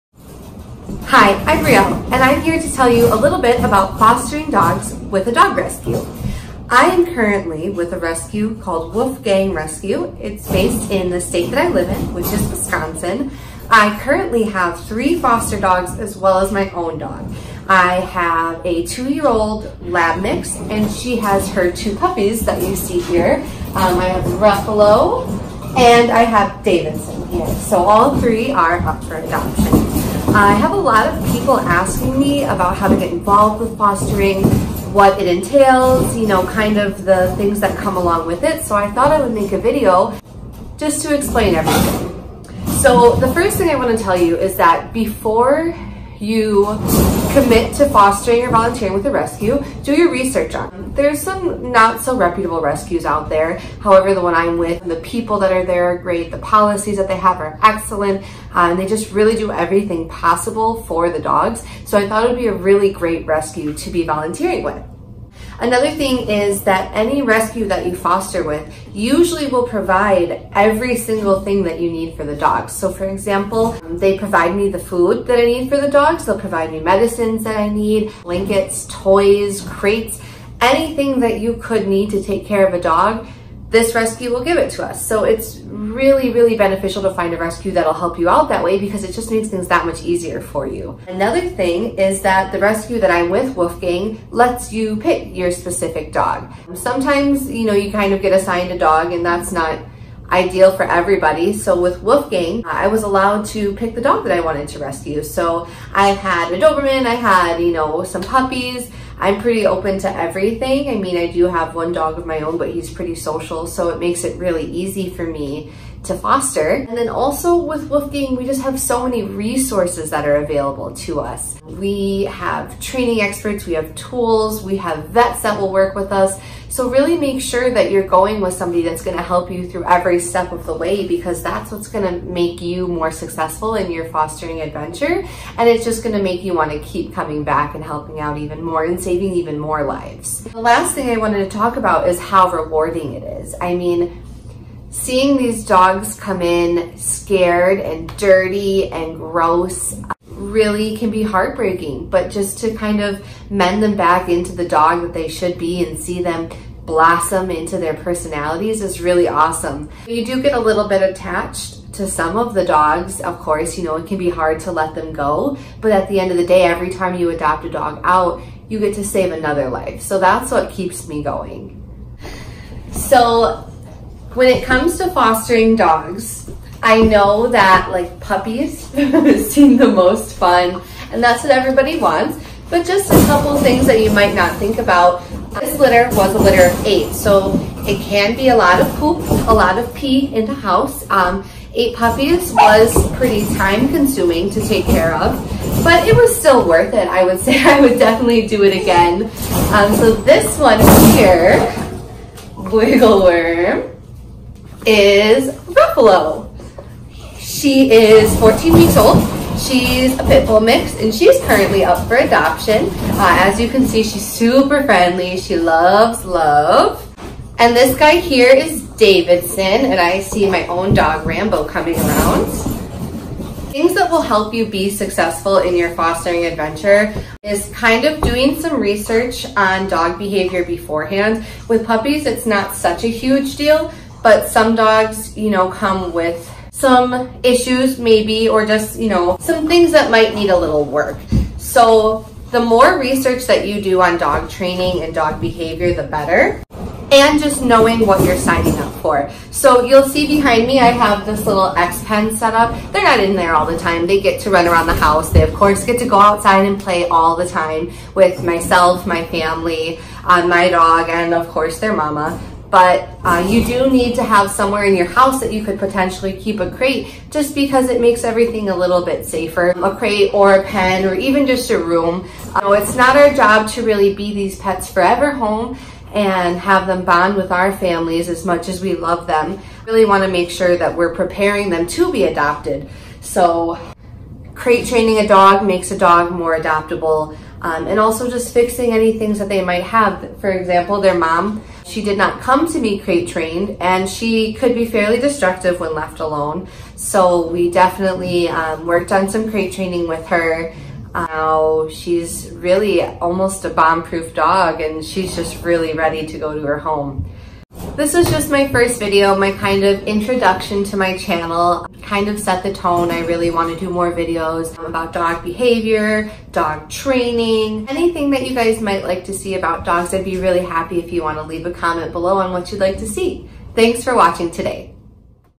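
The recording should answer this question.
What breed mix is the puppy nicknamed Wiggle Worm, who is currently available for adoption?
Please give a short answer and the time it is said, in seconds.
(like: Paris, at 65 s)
Pit bull mix, at 210 s.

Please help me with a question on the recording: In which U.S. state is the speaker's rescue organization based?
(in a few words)
Wisconsin.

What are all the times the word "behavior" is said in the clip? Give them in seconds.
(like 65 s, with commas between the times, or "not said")
230 s, 245 s, 315 s.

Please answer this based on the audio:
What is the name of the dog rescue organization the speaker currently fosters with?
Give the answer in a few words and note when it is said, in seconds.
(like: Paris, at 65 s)
Wolfgang Rescue, at 8 s.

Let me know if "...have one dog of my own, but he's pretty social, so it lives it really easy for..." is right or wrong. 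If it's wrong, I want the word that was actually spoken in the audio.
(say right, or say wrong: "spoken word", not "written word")
wrong: "makes", not "lives".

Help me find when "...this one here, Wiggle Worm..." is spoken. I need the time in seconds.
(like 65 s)
200 s.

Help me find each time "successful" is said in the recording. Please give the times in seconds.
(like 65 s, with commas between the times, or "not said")
133 s, 224 s.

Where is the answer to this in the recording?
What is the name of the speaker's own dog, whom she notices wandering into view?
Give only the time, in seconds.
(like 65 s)
221 s.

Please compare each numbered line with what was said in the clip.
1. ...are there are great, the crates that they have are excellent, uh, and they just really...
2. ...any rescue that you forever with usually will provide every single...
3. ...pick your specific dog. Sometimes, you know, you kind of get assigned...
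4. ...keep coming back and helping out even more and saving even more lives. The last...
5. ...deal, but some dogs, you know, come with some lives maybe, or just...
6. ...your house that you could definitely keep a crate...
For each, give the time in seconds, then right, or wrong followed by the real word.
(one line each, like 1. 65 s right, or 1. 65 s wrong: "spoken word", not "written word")
1. 55 s wrong: "policies", not "crates"
2. 66 s wrong: "foster", not "forever"
3. 94 s right
4. 136 s right
5. 233 s wrong: "issues", not "lives"
6. 264 s wrong: "potentially", not "definitely".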